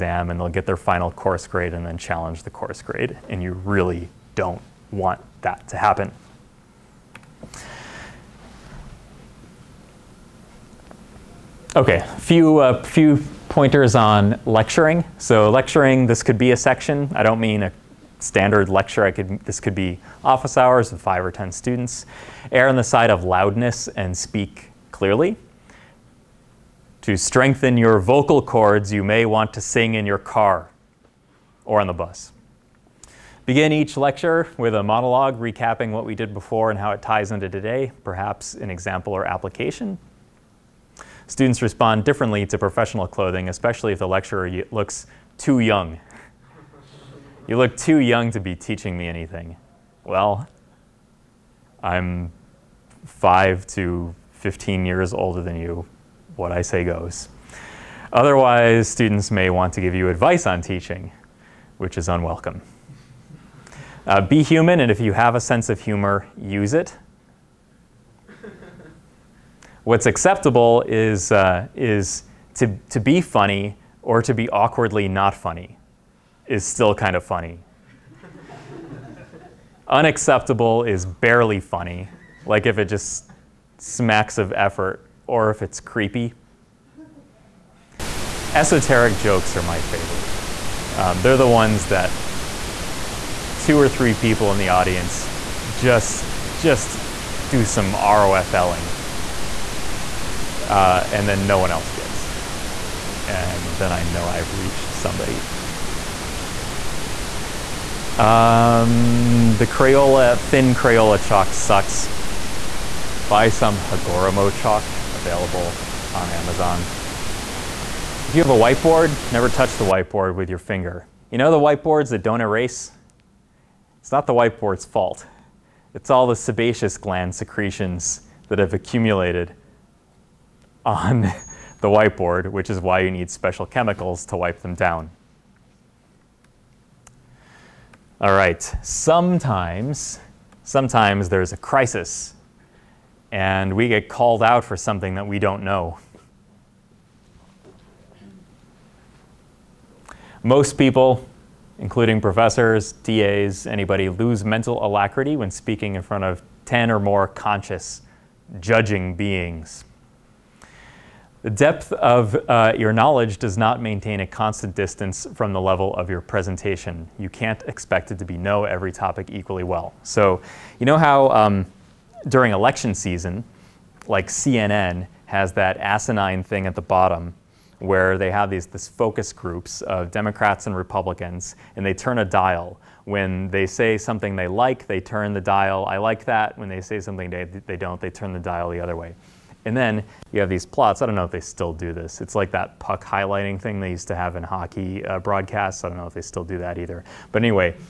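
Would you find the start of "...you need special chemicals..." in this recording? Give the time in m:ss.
2:12.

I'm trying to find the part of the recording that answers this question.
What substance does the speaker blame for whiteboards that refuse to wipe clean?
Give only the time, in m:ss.
2:06.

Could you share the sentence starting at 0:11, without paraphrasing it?
Okay, few uh, few pointers on lecturing.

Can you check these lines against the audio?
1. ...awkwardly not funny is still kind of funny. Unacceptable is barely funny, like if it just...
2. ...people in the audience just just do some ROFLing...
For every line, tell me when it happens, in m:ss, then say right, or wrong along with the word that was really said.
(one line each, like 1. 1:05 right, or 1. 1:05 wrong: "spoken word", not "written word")
1. 1:14 right
2. 1:34 right.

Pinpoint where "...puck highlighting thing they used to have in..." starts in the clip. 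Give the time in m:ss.
3:12.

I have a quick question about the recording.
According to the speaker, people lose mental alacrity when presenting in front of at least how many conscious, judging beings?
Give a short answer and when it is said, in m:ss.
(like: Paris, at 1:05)
10, at 2:36.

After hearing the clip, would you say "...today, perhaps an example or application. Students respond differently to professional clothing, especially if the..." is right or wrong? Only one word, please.
right.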